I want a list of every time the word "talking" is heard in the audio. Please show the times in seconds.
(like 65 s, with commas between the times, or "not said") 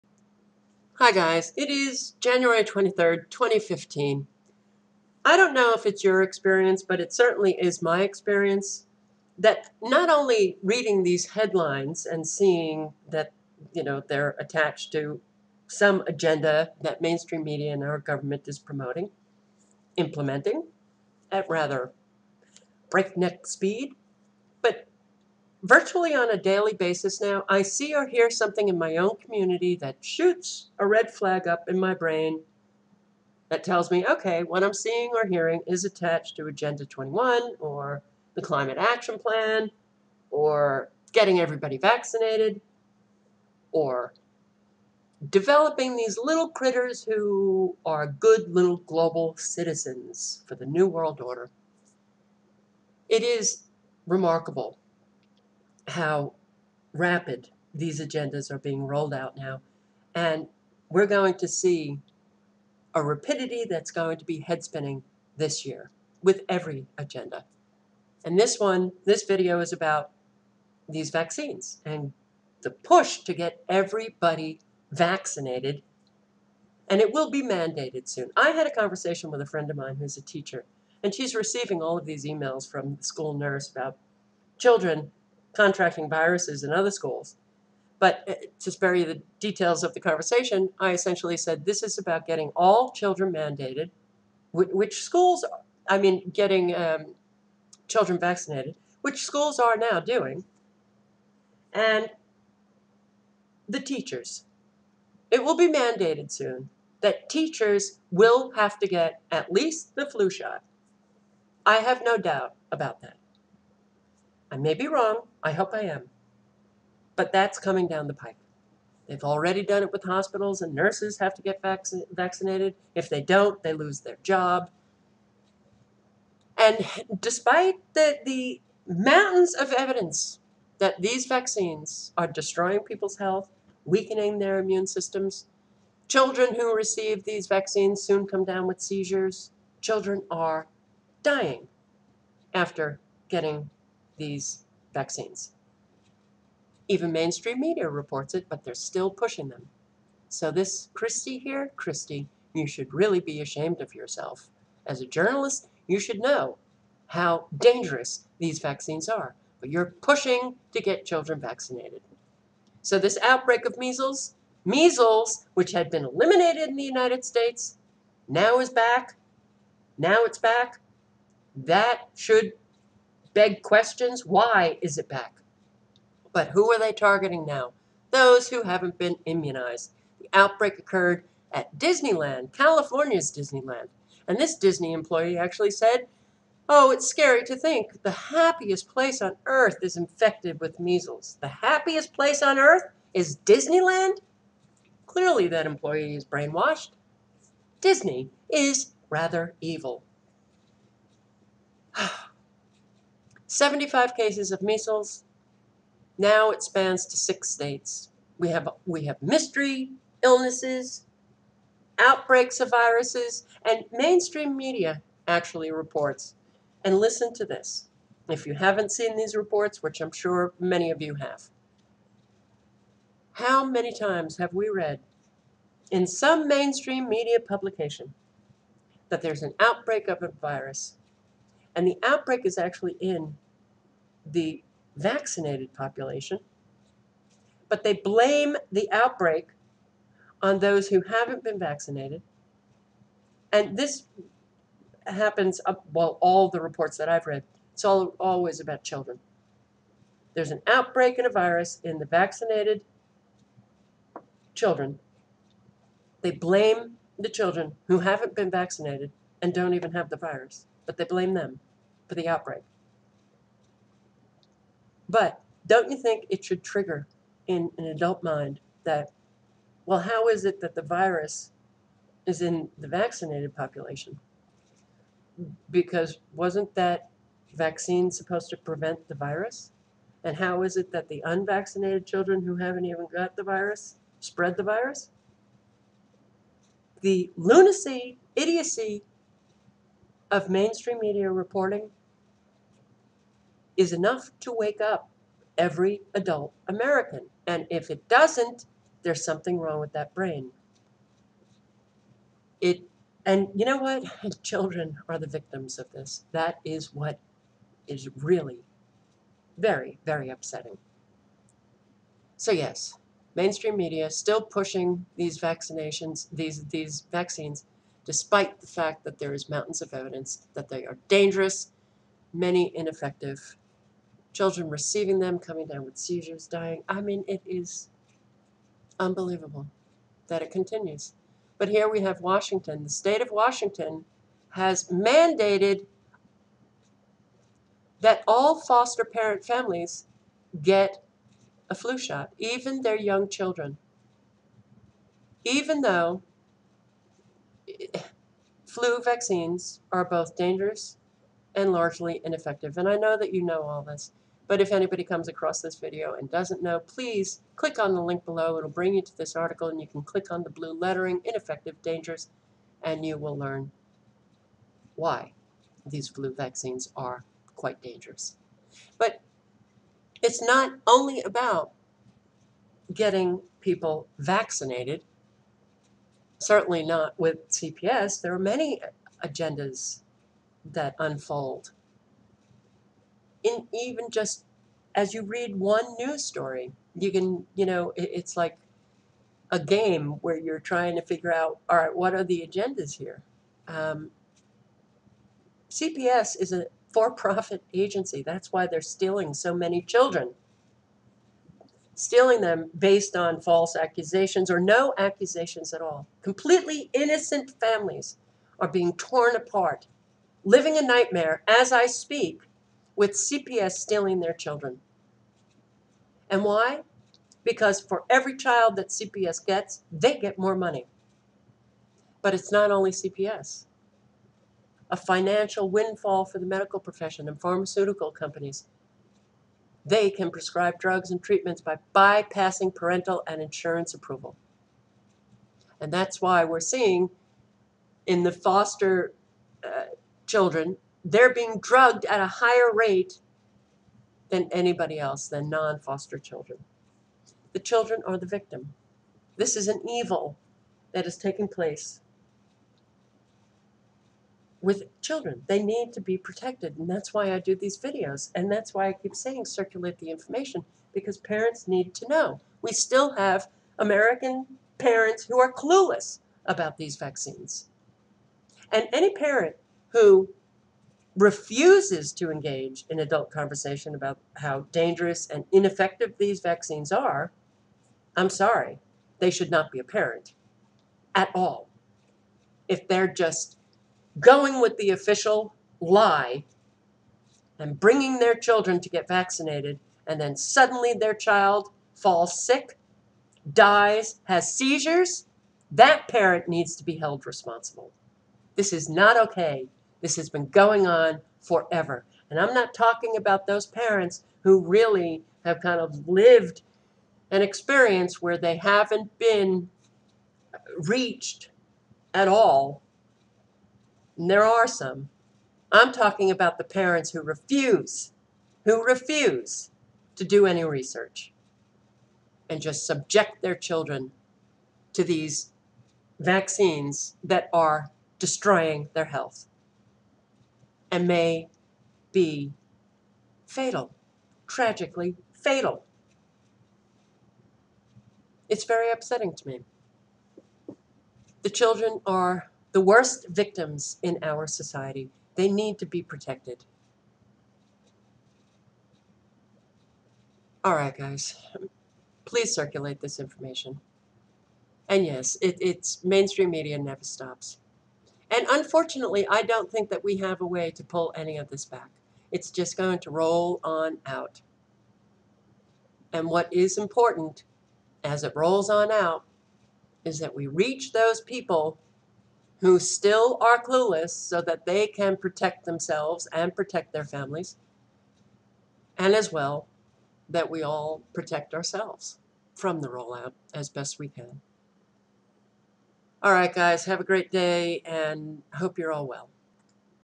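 502 s, 515 s.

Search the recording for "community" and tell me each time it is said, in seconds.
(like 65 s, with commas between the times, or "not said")
29 s.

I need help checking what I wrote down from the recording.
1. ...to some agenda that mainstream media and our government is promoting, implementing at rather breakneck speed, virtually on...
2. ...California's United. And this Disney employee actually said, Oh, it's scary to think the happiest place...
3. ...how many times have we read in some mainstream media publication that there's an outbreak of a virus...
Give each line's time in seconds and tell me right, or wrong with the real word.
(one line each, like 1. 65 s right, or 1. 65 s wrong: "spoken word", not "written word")
1. 14 s right
2. 182 s wrong: "Disneyland", not "United"
3. 223 s right.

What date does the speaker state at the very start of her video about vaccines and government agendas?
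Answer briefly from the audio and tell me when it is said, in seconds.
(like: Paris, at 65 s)
January 23, 2015, at 2 s.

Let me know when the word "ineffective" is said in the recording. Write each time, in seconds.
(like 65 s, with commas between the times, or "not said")
322 s, 352 s, 361 s, 475 s.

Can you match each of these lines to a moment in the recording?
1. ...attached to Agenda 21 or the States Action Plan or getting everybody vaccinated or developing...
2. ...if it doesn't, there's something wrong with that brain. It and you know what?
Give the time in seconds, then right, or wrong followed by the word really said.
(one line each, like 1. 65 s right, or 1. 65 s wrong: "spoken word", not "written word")
1. 35 s wrong: "Climate", not "States"
2. 297 s right.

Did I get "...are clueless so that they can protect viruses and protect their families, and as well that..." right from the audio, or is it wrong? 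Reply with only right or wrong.
wrong.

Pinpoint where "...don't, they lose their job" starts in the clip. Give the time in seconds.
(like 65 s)
123 s.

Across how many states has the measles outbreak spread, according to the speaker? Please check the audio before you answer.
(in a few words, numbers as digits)
6.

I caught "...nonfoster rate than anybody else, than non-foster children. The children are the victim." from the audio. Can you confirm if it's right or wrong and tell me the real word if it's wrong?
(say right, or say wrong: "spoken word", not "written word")
wrong: "higher", not "nonfoster".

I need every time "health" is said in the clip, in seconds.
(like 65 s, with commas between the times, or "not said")
133 s, 529 s.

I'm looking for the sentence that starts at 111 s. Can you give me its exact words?
I have no doubt about that.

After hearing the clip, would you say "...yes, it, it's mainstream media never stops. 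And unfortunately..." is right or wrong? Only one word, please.
right.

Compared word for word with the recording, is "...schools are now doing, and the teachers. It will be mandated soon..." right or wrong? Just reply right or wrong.
right.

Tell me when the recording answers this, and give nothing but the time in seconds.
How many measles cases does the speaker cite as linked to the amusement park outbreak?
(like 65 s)
203 s.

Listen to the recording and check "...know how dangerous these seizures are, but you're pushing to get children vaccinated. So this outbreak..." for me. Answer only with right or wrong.
wrong.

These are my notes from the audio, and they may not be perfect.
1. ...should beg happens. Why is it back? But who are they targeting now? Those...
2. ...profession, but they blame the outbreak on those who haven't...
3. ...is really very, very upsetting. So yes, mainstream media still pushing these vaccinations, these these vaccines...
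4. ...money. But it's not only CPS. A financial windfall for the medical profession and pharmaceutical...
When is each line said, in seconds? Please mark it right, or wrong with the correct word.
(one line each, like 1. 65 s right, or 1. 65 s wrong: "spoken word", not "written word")
1. 172 s wrong: "questions", not "happens"
2. 235 s wrong: "population", not "profession"
3. 307 s right
4. 420 s right.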